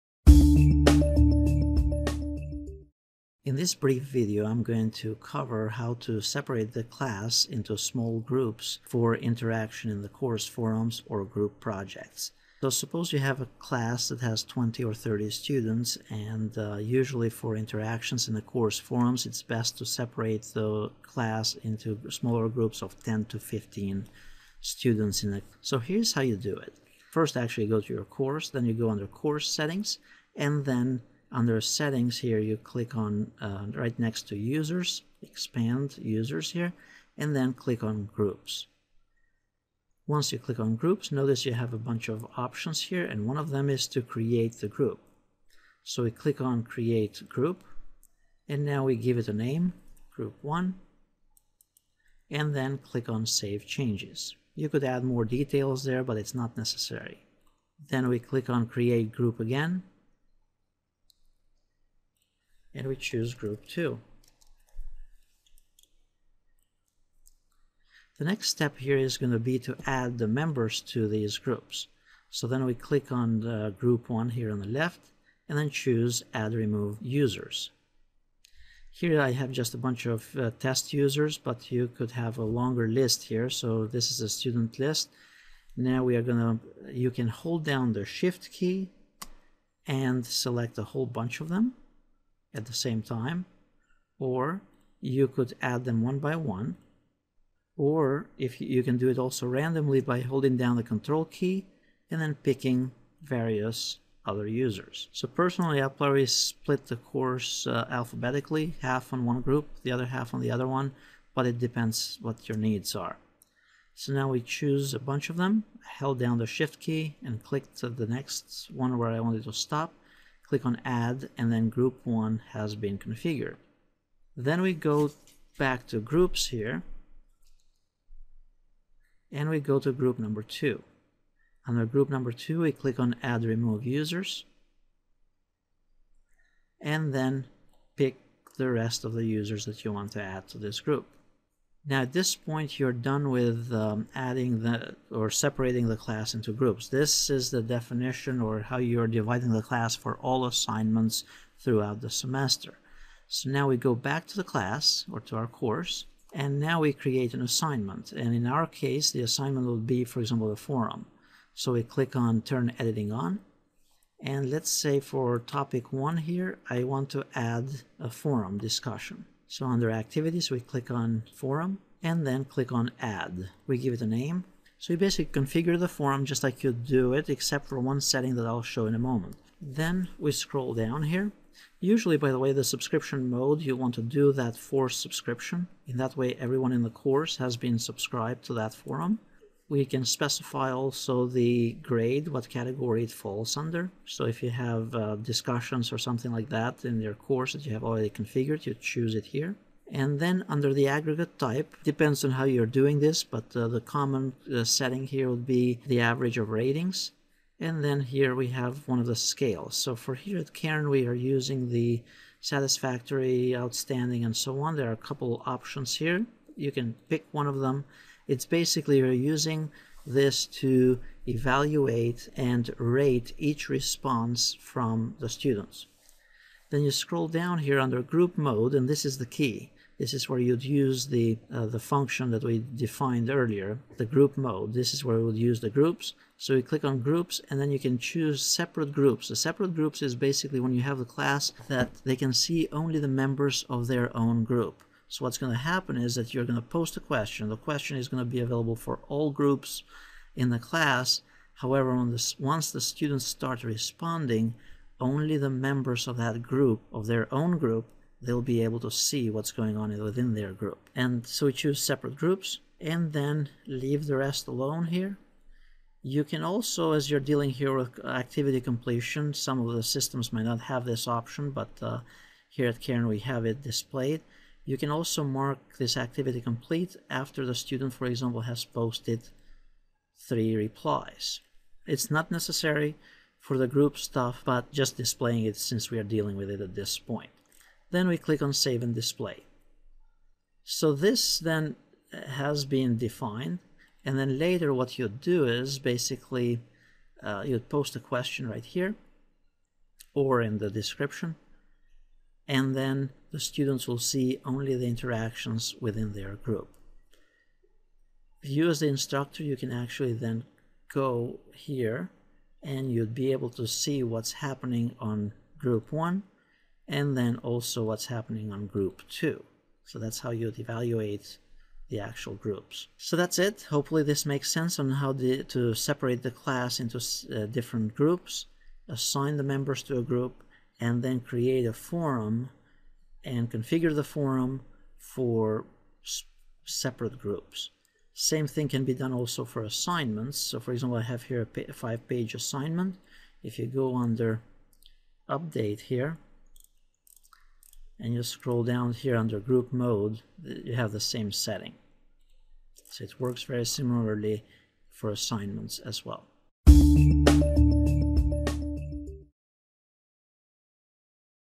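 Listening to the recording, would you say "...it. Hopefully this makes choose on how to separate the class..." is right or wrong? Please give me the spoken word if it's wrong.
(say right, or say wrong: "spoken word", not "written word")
wrong: "sense", not "choose".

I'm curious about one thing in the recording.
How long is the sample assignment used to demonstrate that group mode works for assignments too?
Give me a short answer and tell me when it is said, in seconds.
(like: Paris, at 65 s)
5 pages, at 341 s.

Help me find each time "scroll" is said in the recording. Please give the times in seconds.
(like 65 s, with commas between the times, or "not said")
180 s, 226 s, 348 s.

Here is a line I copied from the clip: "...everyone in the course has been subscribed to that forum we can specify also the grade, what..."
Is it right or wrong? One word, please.
right.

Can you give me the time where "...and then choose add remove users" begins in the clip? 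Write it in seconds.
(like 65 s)
75 s.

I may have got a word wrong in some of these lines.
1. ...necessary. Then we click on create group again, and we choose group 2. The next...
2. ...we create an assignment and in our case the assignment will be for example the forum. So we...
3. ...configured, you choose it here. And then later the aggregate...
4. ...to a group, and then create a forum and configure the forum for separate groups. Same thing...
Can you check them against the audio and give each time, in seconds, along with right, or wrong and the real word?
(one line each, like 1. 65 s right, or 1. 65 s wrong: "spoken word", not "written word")
1. 56 s right
2. 156 s right
3. 198 s wrong: "under", not "later"
4. 329 s right.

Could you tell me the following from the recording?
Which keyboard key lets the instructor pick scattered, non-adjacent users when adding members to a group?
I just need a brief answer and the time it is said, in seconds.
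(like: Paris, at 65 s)
Control, at 100 s.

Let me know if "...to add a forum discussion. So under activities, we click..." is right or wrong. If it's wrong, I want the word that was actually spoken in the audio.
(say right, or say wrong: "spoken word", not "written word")
right.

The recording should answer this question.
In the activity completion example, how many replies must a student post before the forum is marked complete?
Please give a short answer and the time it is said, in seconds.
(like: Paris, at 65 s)
3, at 280 s.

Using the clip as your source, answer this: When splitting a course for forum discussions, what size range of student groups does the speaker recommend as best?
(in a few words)
10 to 15 students.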